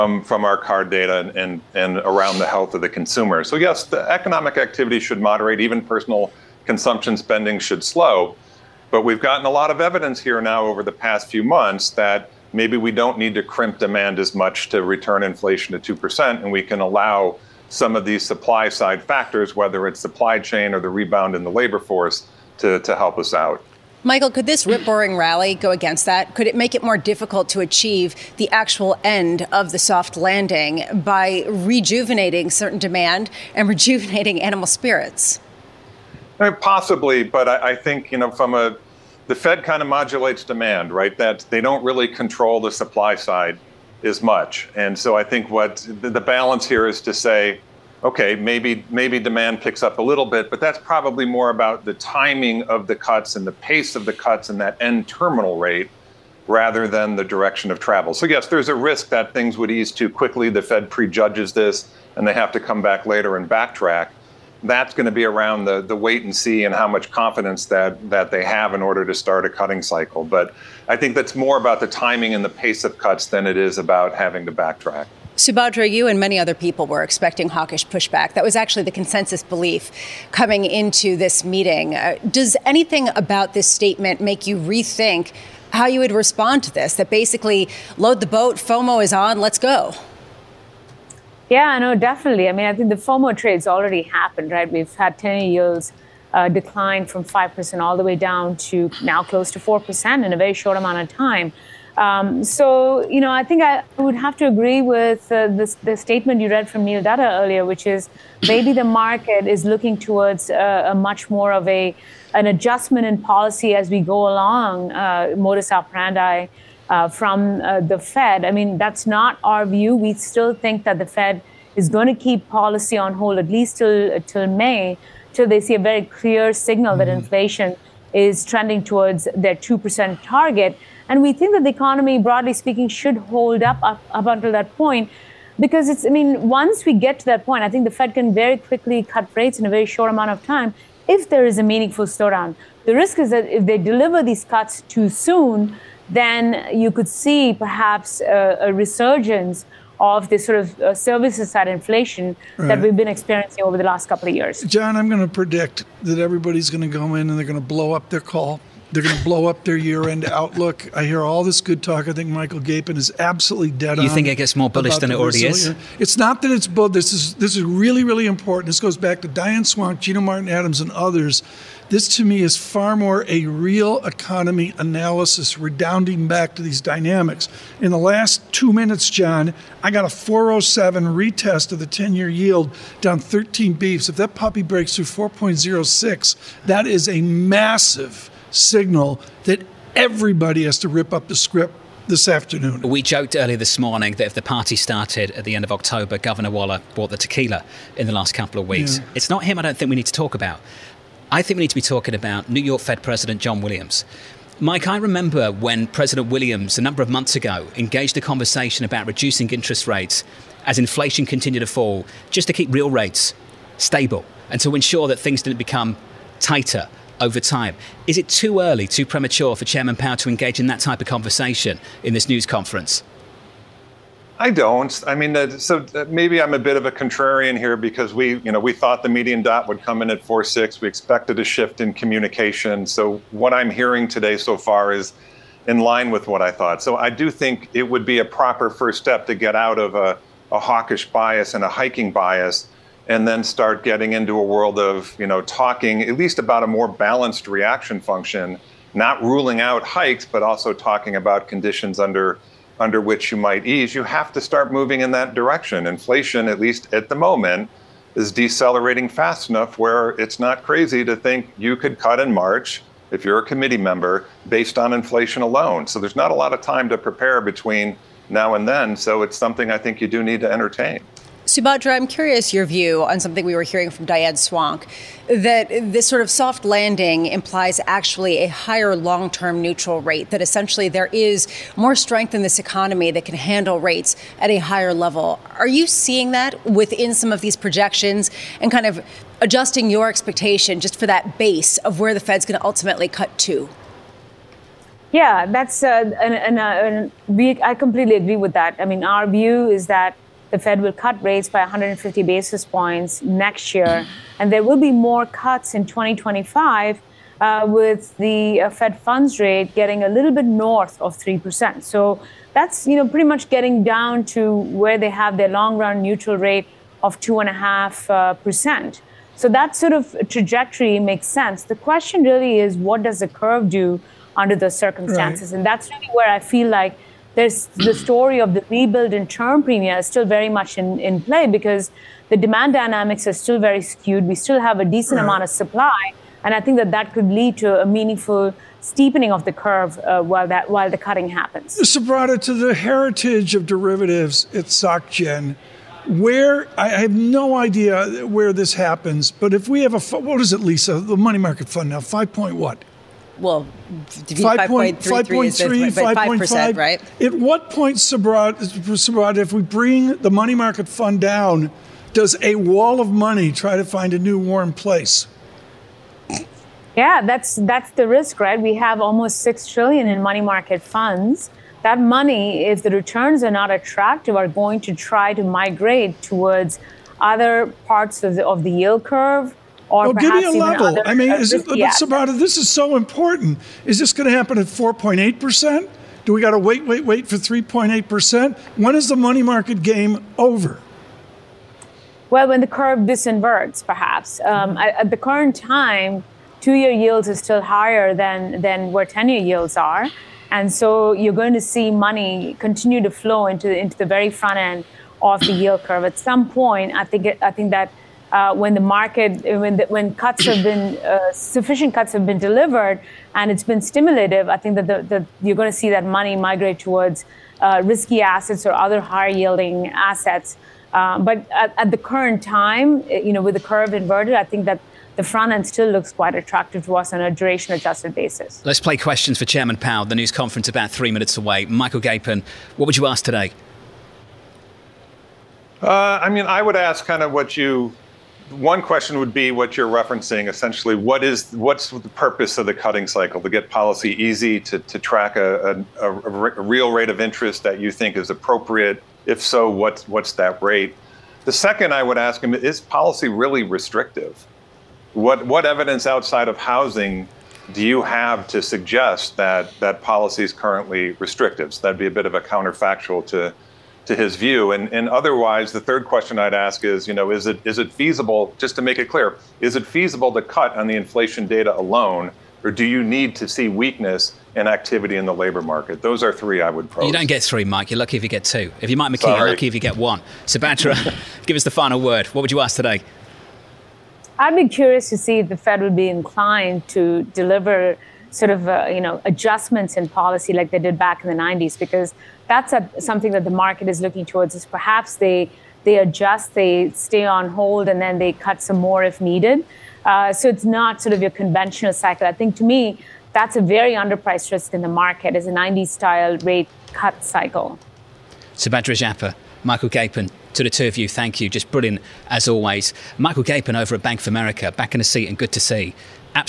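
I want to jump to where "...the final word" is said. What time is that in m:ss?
8:01.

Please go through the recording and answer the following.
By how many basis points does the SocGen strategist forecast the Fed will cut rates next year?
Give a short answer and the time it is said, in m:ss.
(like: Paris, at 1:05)
150, at 5:01.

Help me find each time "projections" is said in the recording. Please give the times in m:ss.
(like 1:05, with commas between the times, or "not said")
4:47.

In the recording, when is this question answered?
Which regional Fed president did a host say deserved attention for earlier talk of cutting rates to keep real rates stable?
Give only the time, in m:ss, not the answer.
3:23.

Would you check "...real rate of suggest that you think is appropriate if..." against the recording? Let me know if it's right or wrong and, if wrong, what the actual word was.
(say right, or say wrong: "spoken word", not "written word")
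wrong: "interest", not "suggest".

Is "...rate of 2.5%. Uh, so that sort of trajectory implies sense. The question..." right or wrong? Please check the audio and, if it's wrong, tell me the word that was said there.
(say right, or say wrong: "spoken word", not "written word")
wrong: "makes", not "implies".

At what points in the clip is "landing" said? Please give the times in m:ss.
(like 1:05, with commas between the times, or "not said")
0:30, 4:36.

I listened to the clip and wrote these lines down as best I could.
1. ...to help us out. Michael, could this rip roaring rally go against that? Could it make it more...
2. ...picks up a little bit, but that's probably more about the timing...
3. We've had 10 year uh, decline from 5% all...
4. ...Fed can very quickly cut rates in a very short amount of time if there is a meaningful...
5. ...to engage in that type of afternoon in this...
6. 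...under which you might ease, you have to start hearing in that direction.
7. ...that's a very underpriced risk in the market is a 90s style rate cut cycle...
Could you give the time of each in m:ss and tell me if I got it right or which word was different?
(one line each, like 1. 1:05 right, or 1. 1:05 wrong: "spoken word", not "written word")
1. 0:22 right
2. 0:49 right
3. 1:34 right
4. 2:17 right
5. 3:40 wrong: "conversation", not "afternoon"
6. 4:12 wrong: "moving", not "hearing"
7. 8:23 right.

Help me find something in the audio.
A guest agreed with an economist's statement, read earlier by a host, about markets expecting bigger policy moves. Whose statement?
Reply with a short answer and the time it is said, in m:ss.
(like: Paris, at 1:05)
Neil Dutta, at 1:46.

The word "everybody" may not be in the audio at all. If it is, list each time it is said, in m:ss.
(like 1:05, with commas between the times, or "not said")
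2:36, 3:09.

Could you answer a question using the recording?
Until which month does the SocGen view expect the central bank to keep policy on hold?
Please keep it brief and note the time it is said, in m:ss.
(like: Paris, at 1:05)
May, at 2:04.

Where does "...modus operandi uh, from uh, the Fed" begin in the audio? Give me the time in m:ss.
1:55.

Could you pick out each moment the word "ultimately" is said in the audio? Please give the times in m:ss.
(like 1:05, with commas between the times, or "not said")
4:52.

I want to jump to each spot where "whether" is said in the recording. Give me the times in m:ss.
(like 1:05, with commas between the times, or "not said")
0:19.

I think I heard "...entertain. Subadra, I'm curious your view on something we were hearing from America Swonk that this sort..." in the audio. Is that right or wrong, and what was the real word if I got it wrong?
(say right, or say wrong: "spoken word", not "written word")
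wrong: "Diane", not "America".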